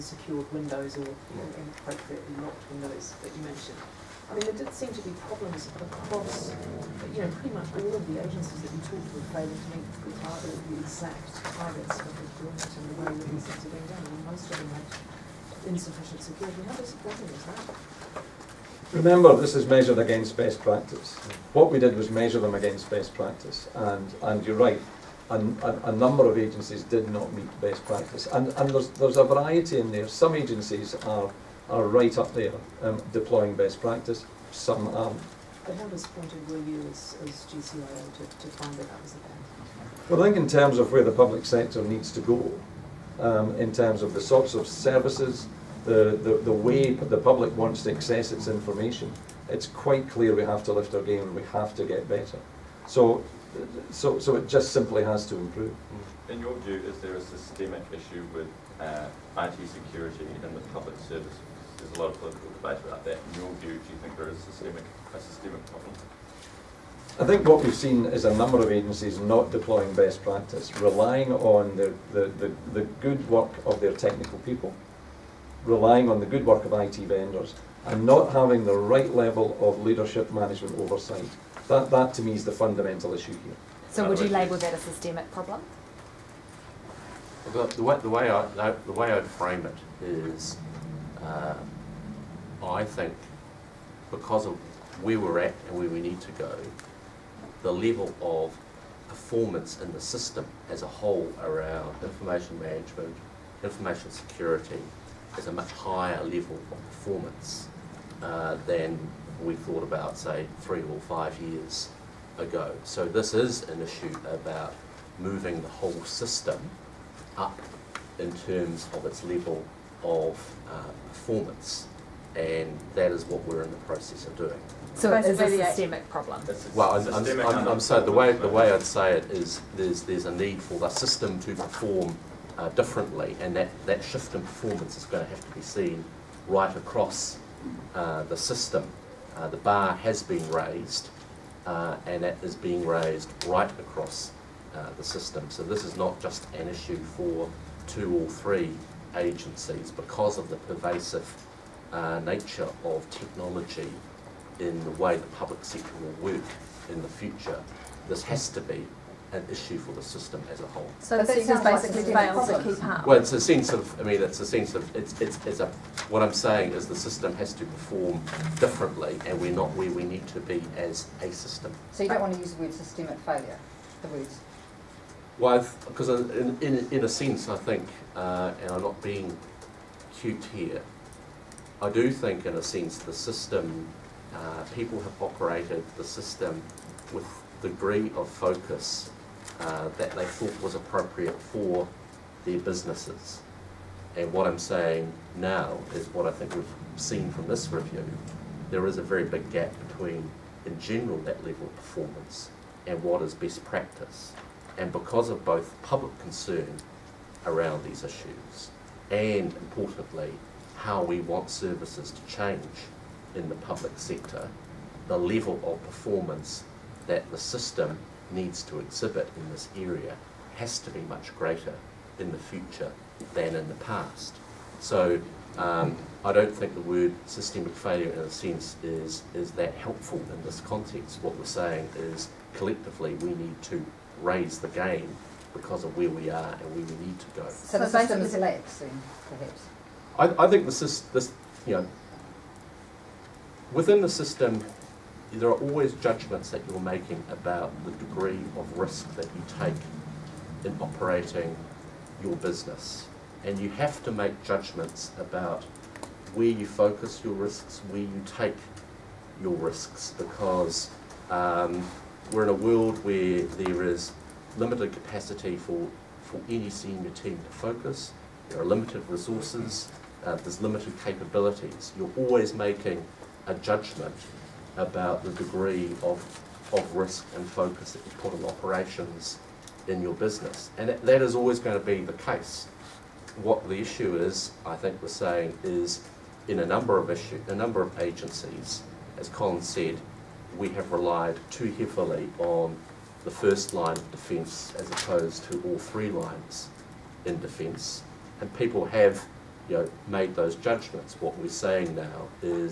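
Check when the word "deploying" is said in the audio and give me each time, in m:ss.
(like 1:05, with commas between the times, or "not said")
0:33, 1:09.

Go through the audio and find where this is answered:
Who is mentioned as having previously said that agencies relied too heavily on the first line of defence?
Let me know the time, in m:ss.
4:49.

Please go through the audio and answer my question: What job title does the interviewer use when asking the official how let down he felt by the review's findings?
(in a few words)
GCIO.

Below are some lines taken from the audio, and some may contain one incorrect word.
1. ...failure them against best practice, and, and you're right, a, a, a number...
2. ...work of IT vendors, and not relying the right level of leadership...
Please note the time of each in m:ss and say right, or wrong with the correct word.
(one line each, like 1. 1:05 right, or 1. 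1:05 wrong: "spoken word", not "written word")
1. 0:22 wrong: "measure", not "failure"
2. 1:16 wrong: "having", not "relying".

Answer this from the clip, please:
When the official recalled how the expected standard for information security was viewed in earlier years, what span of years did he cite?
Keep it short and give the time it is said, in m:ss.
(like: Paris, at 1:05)
three or five years ago, at 1:50.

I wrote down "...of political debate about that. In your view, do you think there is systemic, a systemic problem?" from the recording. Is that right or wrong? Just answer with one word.
right.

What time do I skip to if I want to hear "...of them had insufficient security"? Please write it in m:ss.
0:14.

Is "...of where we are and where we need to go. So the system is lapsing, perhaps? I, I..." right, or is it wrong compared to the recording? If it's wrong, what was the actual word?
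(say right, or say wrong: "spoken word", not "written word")
right.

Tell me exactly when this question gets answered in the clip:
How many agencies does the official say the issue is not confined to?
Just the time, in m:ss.
2:27.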